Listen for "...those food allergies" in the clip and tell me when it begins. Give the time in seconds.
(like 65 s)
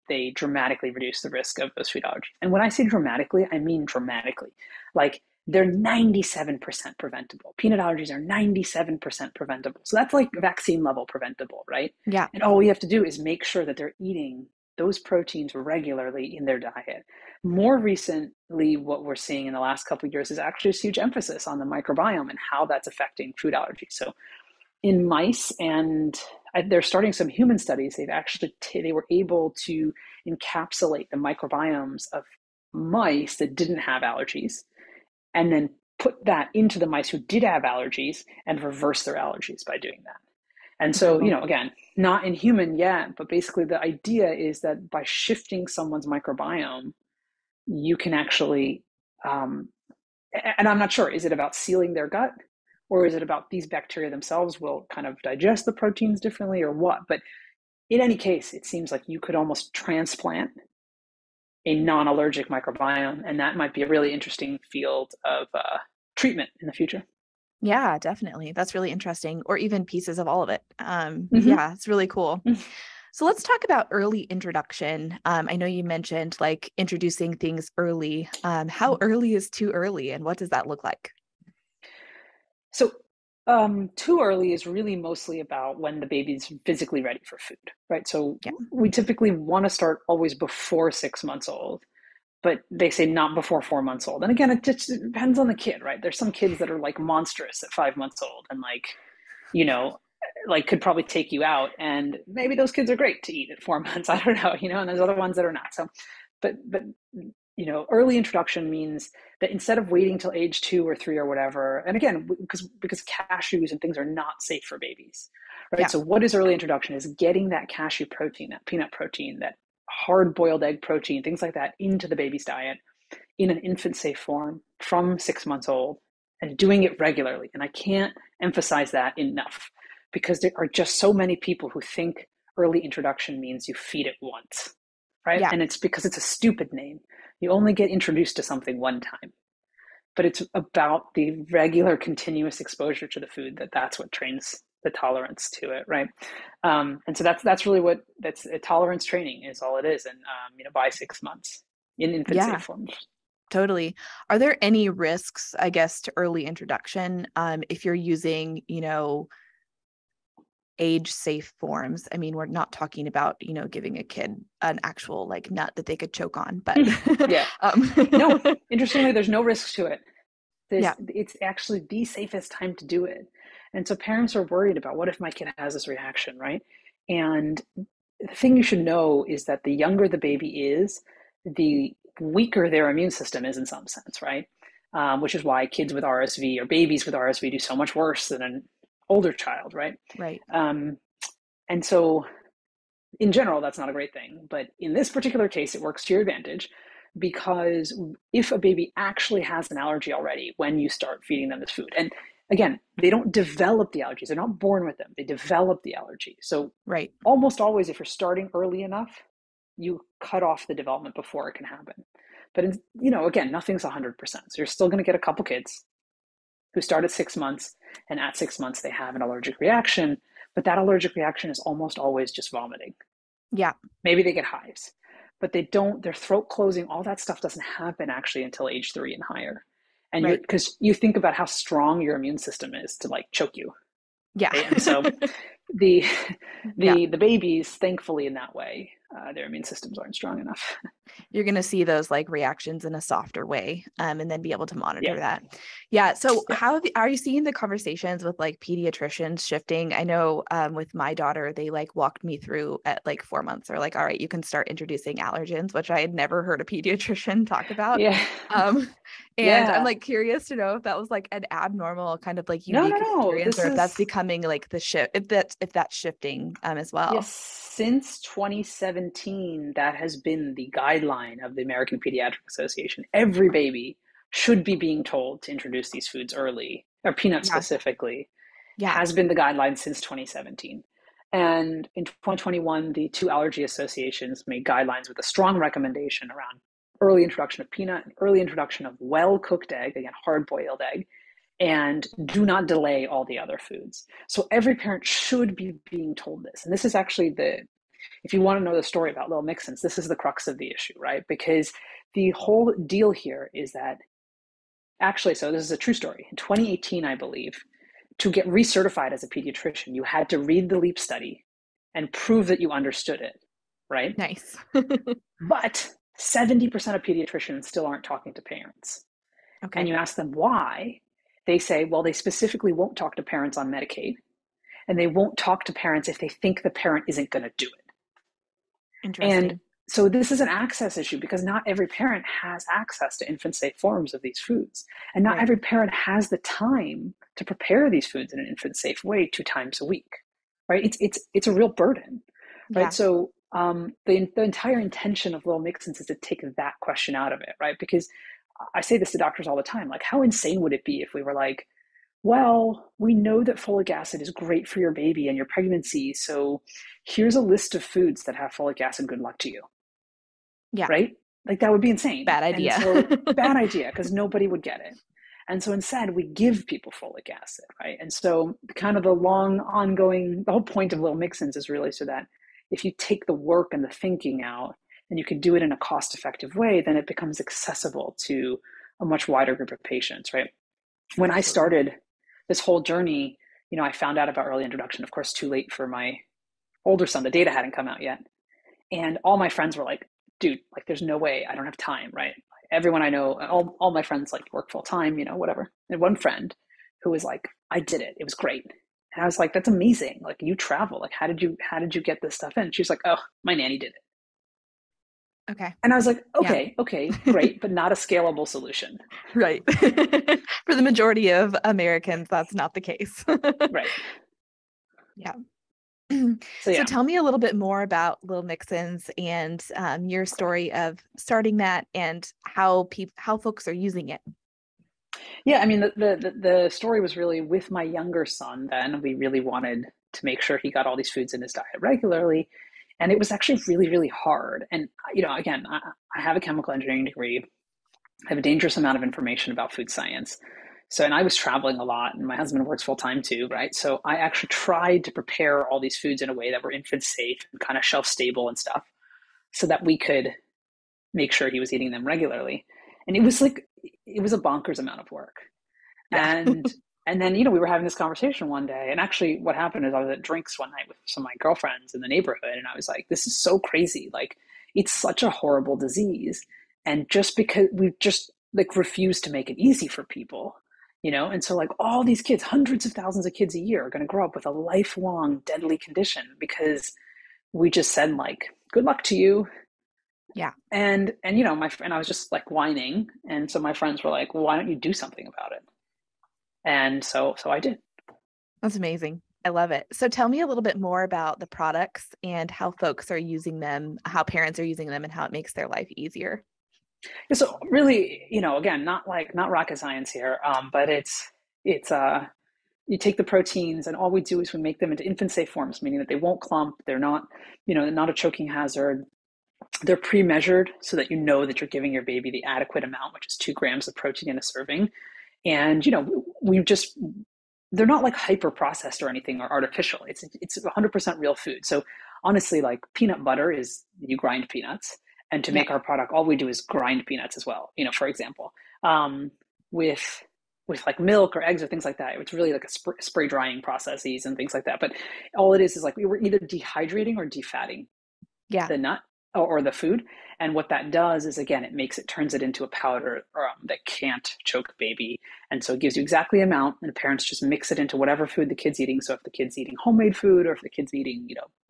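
1 s.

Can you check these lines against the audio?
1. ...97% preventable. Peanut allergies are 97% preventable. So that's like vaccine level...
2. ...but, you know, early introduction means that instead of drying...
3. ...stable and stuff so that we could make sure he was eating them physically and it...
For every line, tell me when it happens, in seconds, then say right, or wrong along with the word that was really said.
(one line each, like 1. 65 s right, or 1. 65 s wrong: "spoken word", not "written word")
1. 5 s right
2. 106 s wrong: "waiting", not "drying"
3. 448 s wrong: "regularly", not "physically".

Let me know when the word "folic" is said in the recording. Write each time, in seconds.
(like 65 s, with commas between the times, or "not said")
353 s, 358 s, 366 s.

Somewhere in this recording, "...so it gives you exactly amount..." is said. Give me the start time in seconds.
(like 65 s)
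545 s.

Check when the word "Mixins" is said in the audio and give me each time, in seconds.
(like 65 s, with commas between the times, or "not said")
299 s, 345 s, 371 s, 418 s.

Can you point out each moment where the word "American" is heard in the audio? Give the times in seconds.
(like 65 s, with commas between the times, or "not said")
271 s, 411 s.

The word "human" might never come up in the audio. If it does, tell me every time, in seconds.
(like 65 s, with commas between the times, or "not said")
27 s, 42 s.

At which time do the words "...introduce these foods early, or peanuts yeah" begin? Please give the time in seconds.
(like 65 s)
275 s.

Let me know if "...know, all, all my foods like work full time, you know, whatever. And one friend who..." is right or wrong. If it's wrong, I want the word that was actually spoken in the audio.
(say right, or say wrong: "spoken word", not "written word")
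wrong: "friends", not "foods".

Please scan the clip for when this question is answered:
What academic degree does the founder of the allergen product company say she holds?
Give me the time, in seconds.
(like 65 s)
436 s.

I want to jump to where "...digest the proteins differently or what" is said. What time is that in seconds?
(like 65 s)
55 s.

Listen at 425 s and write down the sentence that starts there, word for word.
Yeah, I mean the, the the story was really with my younger son.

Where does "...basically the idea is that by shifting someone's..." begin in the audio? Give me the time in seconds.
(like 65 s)
43 s.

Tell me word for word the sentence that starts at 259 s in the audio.
I'm like curious to know if that was like an abnormal kind of like unique no, no, experience, no.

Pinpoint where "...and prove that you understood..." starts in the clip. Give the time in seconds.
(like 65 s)
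311 s.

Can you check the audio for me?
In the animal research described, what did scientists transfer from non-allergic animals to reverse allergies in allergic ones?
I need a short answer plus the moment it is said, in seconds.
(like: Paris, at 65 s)
microbiomes, at 31 s.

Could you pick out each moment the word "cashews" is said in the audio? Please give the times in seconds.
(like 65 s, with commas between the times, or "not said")
113 s, 117 s.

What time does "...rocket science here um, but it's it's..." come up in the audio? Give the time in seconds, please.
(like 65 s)
499 s.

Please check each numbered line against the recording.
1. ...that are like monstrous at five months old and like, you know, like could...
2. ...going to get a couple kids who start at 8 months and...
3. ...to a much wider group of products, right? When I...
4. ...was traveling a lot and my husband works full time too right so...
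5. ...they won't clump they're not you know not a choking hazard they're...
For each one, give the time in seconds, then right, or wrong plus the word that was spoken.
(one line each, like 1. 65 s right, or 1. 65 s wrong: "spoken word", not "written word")
1. 96 s right
2. 214 s wrong: "6", not "8"
3. 378 s wrong: "patients", not "products"
4. 441 s right
5. 506 s right.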